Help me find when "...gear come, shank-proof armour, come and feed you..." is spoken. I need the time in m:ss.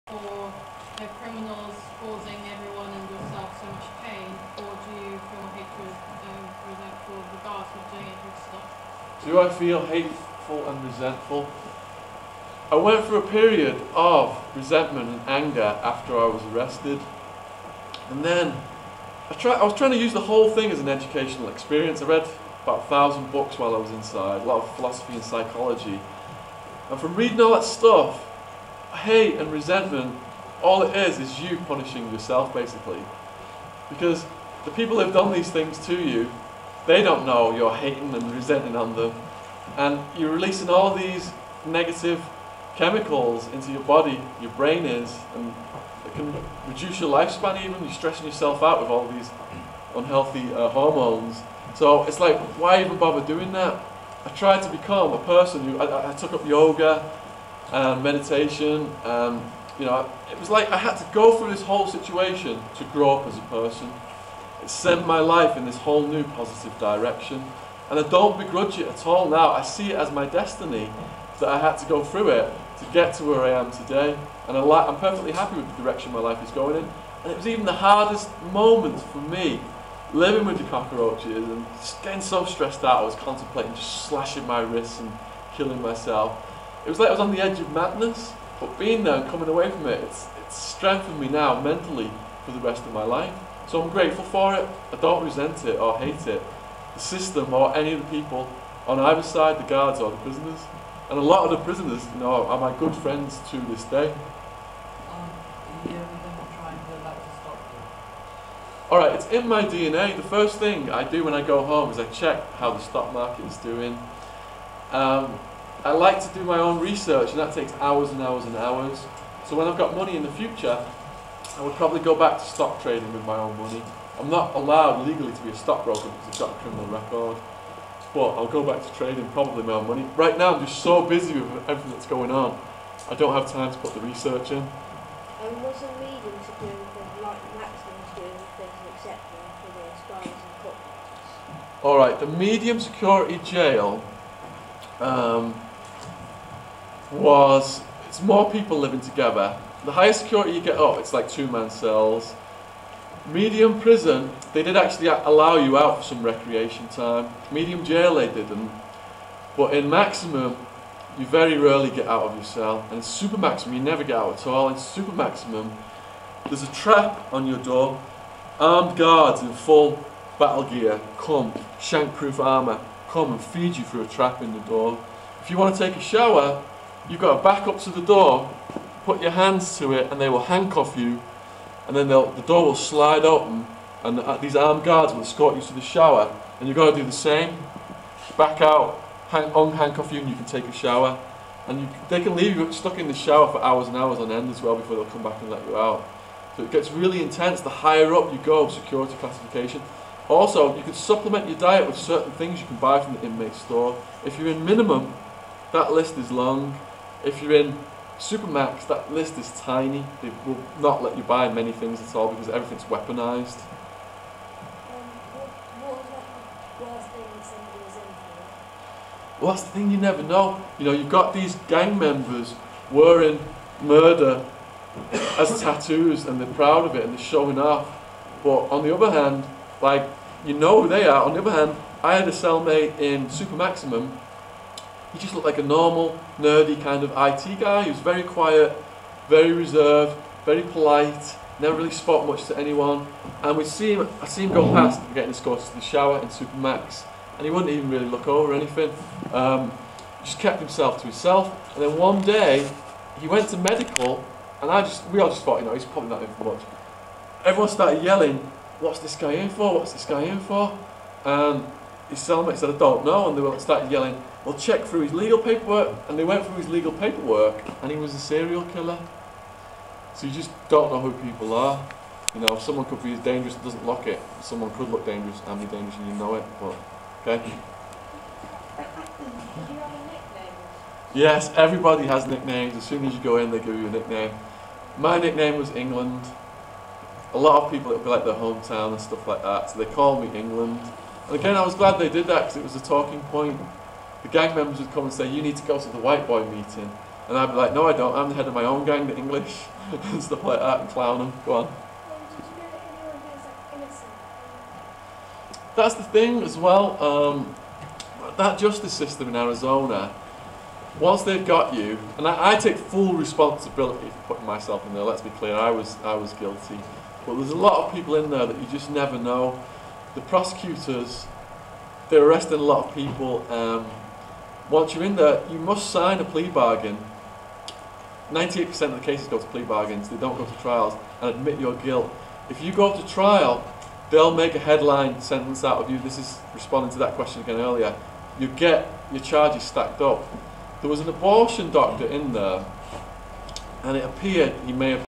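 2:50.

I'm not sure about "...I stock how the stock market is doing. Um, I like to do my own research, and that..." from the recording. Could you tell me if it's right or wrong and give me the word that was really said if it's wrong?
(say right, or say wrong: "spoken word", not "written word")
wrong: "check", not "stock".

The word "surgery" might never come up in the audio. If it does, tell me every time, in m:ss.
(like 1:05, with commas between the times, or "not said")
not said.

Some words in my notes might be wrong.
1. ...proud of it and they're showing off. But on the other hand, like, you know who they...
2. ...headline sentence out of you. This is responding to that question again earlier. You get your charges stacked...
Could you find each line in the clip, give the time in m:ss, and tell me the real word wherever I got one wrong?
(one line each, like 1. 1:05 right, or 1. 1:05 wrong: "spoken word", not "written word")
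1. 3:46 right
2. 5:34 right.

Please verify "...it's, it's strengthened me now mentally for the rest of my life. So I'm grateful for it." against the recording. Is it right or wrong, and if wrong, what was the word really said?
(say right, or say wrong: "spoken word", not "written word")
right.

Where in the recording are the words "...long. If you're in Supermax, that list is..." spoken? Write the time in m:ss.
3:26.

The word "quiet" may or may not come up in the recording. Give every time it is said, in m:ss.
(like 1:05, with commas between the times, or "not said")
3:58.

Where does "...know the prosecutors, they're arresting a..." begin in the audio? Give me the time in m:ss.
5:19.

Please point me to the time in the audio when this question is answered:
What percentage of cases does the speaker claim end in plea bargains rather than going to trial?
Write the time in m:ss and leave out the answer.
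5:28.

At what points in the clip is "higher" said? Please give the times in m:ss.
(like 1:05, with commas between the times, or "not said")
2:29, 3:17.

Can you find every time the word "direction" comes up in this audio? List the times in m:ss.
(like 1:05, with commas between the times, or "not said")
1:06, 1:15.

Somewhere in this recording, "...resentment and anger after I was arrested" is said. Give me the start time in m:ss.
0:14.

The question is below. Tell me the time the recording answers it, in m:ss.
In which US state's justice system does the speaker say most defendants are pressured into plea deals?
5:09.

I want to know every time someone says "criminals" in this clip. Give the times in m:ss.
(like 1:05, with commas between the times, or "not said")
0:01, 2:06.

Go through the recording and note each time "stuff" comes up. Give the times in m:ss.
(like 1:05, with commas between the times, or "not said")
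0:27, 4:48, 5:00.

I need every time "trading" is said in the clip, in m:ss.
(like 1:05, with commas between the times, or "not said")
2:02, 2:08.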